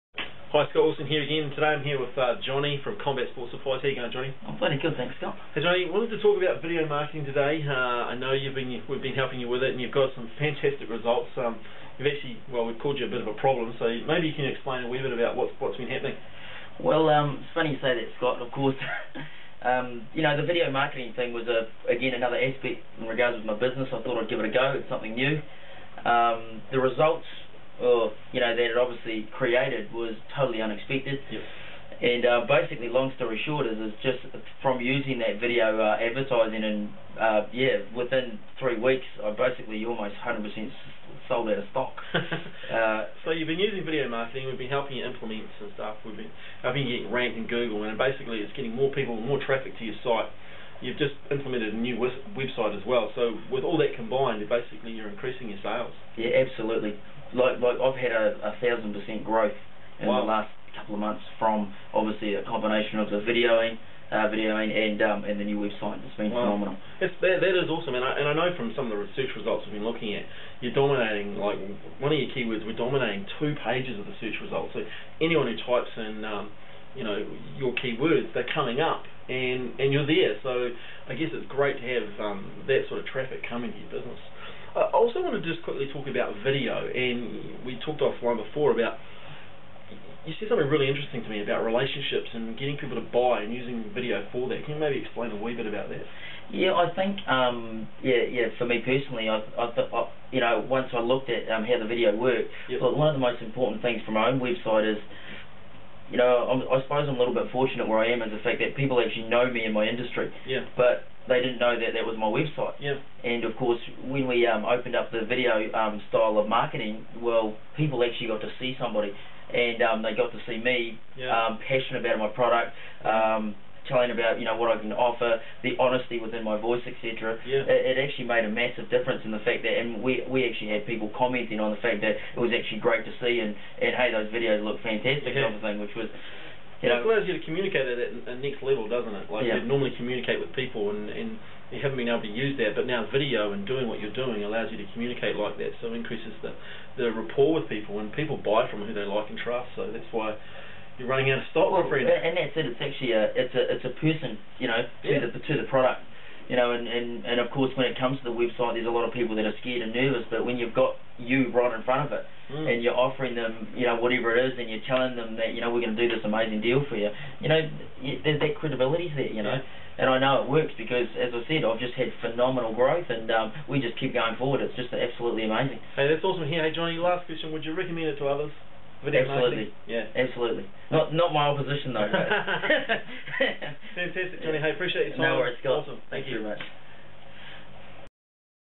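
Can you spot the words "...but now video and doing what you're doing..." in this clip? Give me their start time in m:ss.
2:22.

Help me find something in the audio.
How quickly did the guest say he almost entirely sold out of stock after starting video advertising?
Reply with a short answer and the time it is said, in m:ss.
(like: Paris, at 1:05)
within three weeks, at 0:37.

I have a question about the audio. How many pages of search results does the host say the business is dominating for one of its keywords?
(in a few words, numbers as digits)
2.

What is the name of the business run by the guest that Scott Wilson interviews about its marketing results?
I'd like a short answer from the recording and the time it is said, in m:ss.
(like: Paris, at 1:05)
Combat Sports Supplies, at 0:02.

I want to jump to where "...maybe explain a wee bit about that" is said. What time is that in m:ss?
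1:34.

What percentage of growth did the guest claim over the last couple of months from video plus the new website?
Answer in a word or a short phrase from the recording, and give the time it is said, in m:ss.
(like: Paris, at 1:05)
1000%, at 0:58.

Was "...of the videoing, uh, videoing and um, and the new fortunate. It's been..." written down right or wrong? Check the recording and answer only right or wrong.
wrong.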